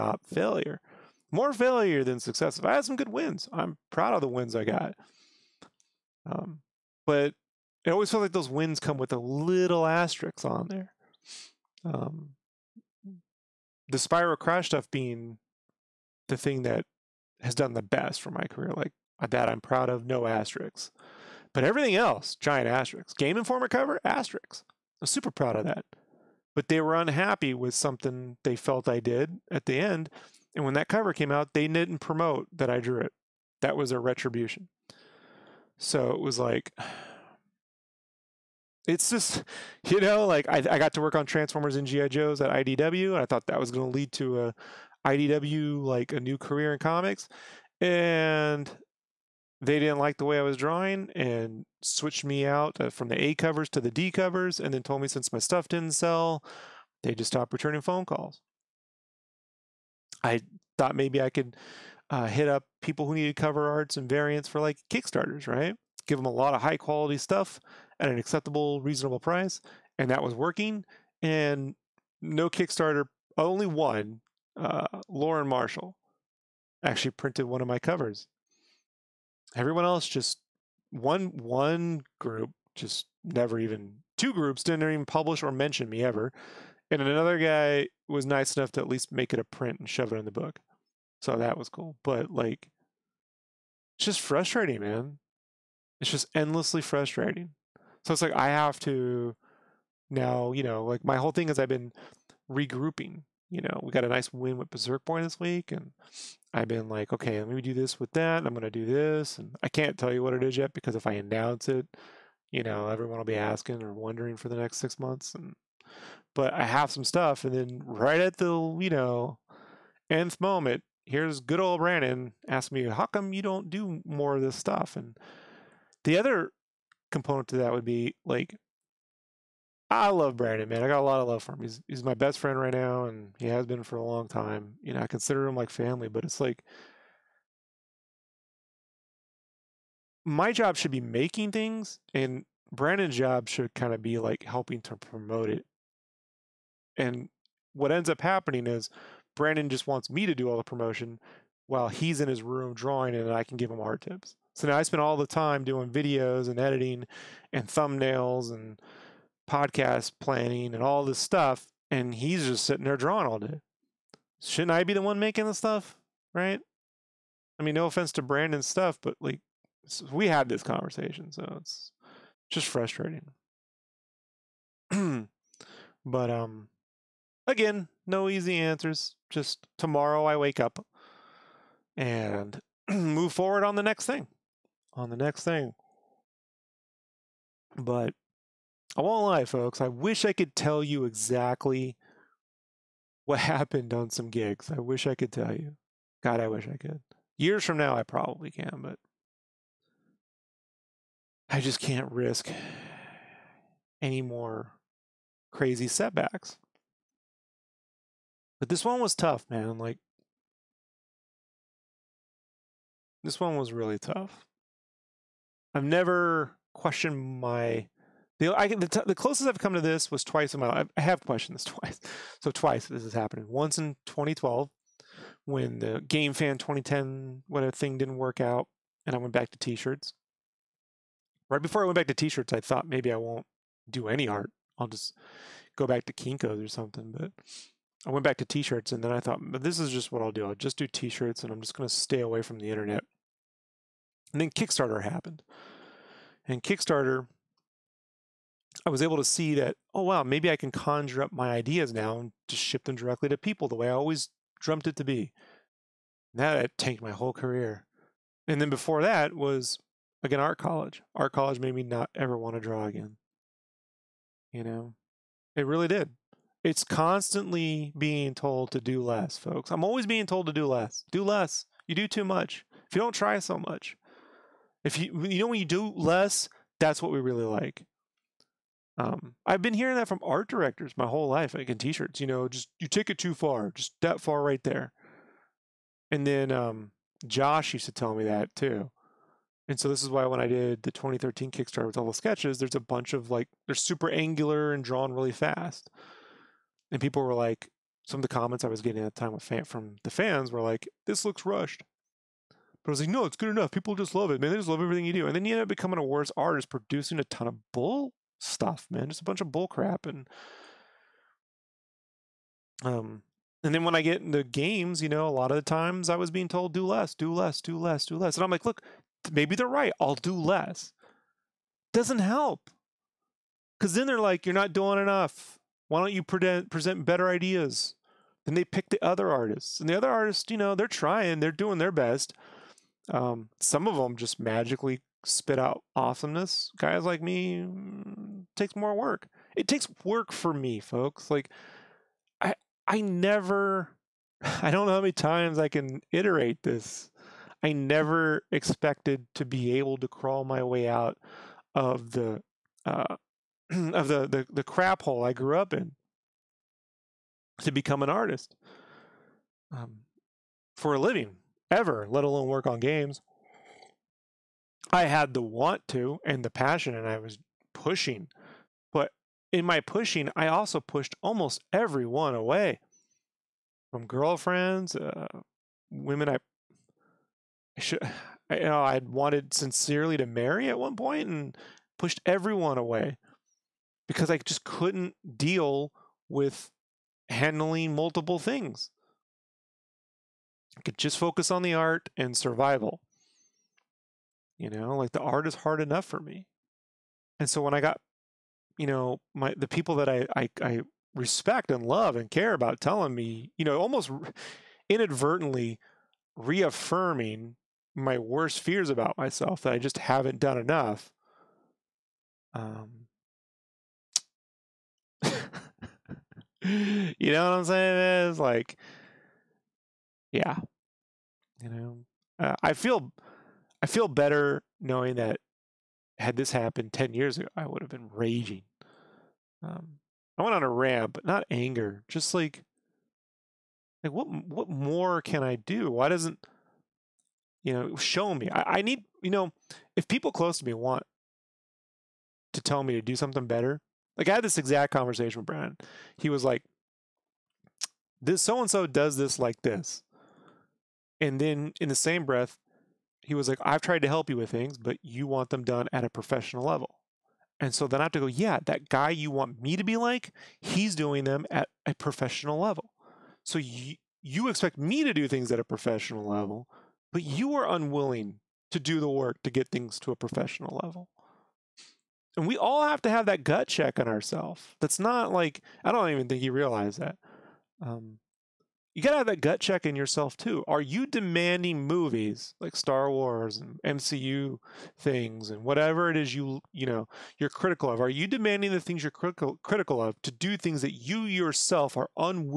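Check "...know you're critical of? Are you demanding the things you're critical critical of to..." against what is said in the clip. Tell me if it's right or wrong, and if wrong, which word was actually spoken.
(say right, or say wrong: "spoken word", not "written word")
right.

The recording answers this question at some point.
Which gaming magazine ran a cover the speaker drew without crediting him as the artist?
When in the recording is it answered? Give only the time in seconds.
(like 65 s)
23 s.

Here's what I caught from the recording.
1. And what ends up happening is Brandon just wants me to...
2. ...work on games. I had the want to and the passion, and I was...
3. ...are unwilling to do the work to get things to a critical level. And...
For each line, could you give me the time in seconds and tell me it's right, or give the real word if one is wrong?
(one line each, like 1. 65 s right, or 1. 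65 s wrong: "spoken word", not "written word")
1. 146 s right
2. 362 s right
3. 467 s wrong: "professional", not "critical".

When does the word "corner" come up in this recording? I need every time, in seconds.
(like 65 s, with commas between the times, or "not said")
not said.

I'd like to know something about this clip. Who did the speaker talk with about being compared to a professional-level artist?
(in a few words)
Brian.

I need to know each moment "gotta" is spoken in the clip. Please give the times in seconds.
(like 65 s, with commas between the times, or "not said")
479 s.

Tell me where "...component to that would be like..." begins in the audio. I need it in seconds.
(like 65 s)
127 s.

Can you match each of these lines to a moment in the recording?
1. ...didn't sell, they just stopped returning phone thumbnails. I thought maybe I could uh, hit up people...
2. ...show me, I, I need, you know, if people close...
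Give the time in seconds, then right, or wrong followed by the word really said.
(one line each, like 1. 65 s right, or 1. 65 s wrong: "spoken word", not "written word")
1. 55 s wrong: "calls", not "thumbnails"
2. 437 s right.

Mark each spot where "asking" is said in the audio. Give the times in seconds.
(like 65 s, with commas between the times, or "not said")
113 s, 122 s.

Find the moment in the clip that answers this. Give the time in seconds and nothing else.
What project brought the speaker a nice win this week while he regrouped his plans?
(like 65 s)
104 s.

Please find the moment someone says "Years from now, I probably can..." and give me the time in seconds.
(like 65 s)
197 s.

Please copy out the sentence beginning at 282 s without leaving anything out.
You know, just you take it too far, just that far right there.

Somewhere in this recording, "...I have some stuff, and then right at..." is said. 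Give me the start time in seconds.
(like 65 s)
116 s.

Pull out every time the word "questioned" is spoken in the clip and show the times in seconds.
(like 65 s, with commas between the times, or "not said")
216 s, 221 s.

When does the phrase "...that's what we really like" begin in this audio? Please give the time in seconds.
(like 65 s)
276 s.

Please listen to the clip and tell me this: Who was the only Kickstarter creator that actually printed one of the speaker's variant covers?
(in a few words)
Lauren Marshall.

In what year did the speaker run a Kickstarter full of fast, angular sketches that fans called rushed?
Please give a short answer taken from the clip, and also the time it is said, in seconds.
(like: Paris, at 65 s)
2013, at 290 s.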